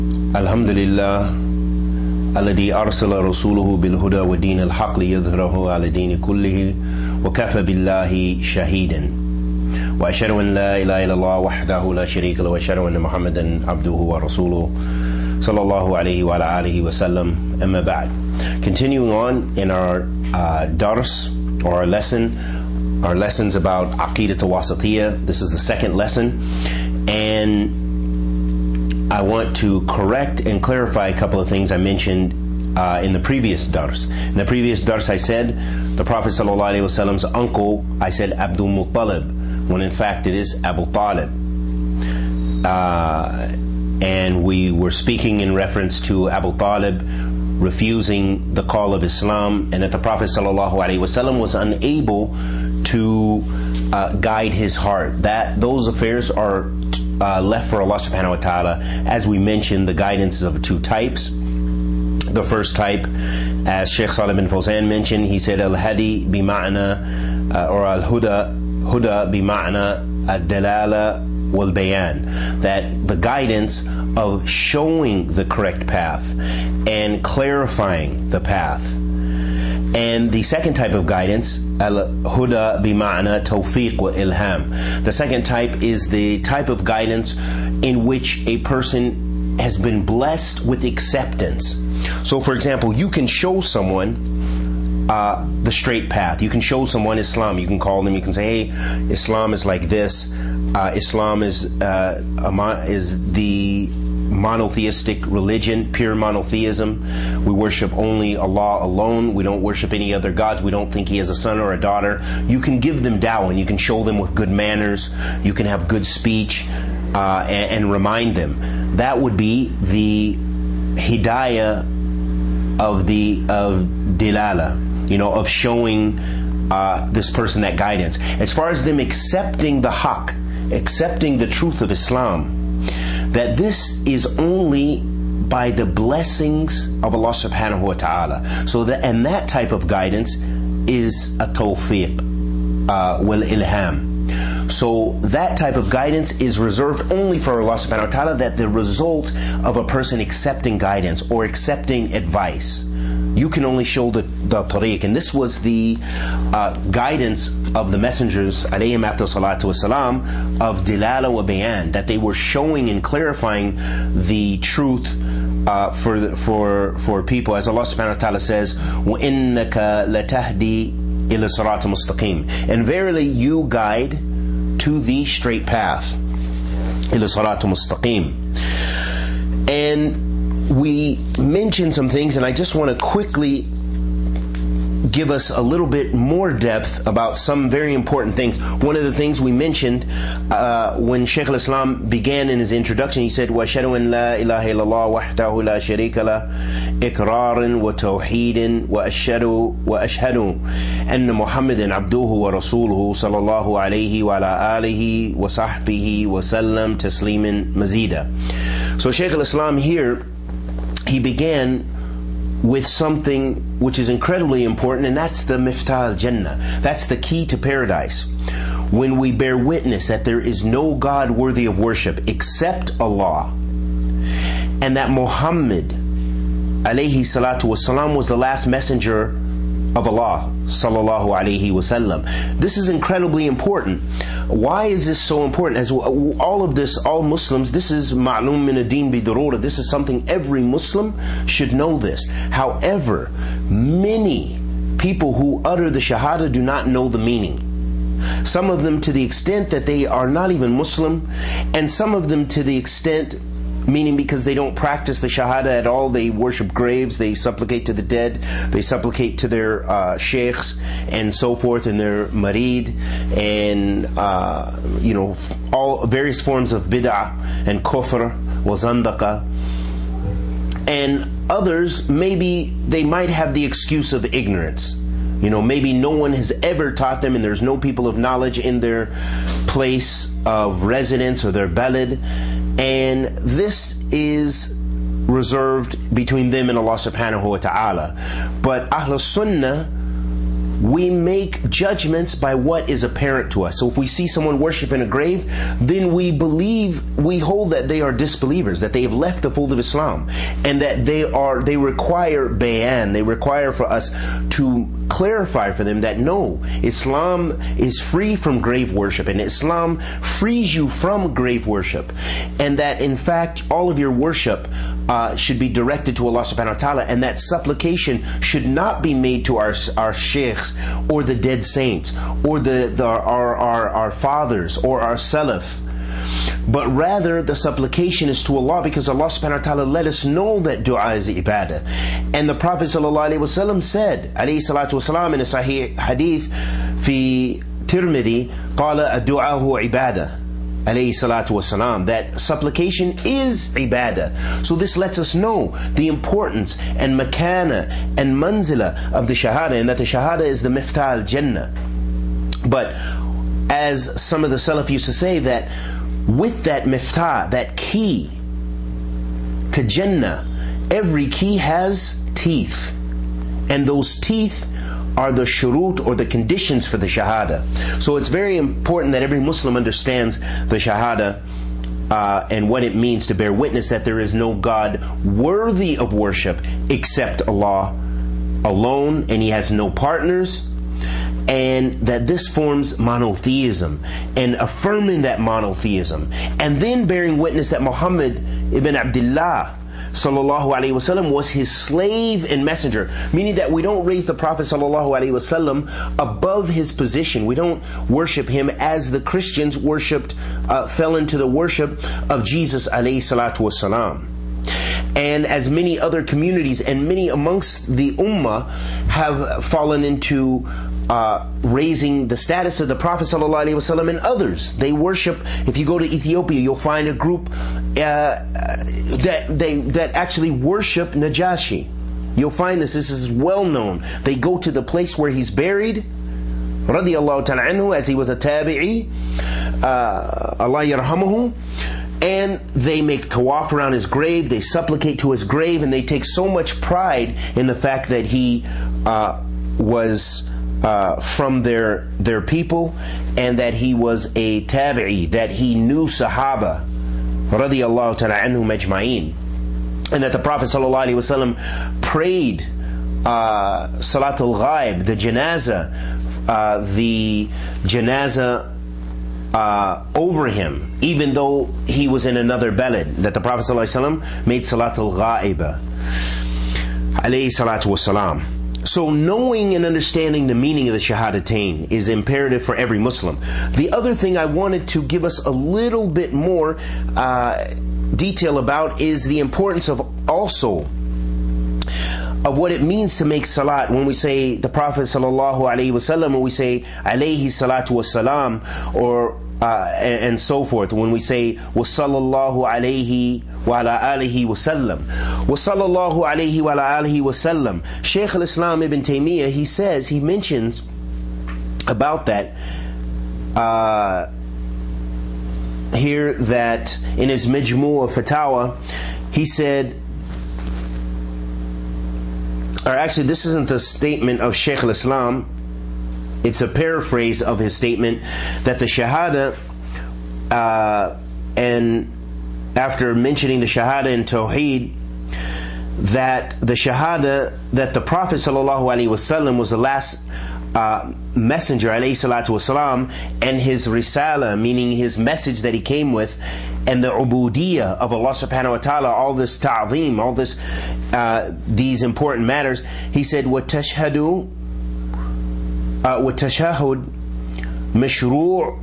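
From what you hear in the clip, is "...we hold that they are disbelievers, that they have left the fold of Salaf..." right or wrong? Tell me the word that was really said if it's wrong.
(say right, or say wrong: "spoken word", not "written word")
wrong: "Islam", not "Salaf".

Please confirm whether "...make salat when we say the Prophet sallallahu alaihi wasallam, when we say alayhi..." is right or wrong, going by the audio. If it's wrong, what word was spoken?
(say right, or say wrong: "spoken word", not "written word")
right.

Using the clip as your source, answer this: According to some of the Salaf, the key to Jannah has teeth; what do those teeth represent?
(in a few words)
The conditions.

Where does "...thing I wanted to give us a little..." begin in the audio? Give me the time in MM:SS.
07:54.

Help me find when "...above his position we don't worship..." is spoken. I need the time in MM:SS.
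06:36.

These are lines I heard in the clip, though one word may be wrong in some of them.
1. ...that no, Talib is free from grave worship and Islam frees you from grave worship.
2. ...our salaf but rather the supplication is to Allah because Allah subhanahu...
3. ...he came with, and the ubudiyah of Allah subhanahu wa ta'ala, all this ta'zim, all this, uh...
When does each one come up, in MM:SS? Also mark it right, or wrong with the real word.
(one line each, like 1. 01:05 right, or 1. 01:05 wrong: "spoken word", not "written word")
1. 05:05 wrong: "Islam", not "Talib"
2. 05:25 right
3. 08:55 right.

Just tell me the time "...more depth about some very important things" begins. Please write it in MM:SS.
03:06.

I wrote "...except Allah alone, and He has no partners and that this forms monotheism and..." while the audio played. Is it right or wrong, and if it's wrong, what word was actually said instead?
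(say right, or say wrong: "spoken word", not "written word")
right.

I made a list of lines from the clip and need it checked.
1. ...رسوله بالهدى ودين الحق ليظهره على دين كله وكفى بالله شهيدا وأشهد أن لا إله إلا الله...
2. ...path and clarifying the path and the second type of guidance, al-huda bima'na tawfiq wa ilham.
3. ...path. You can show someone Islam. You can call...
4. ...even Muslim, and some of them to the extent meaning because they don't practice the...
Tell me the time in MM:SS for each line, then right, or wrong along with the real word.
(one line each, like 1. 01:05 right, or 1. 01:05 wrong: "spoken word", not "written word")
1. 00:03 right
2. 01:15 right
3. 01:36 right
4. 04:10 right.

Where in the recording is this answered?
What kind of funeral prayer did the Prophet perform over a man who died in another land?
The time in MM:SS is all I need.
07:33.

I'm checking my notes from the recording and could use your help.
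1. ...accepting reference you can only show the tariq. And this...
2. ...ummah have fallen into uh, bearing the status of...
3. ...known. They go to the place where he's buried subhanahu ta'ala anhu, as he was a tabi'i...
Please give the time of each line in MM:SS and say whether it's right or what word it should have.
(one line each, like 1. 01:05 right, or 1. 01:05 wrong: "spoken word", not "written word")
1. 02:31 wrong: "advice", not "reference"
2. 06:48 wrong: "raising", not "bearing"
3. 07:03 wrong: "radiallahu", not "subhanahu".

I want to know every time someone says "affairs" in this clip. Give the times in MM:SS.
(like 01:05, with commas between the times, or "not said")
00:55.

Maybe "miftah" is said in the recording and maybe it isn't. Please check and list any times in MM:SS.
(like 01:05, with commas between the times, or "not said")
03:35, 05:50, 05:56.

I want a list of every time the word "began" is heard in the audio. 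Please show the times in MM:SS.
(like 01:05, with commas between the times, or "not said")
03:12, 03:31.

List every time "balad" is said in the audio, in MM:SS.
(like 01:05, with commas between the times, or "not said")
04:41.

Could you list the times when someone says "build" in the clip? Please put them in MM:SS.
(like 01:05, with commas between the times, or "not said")
not said.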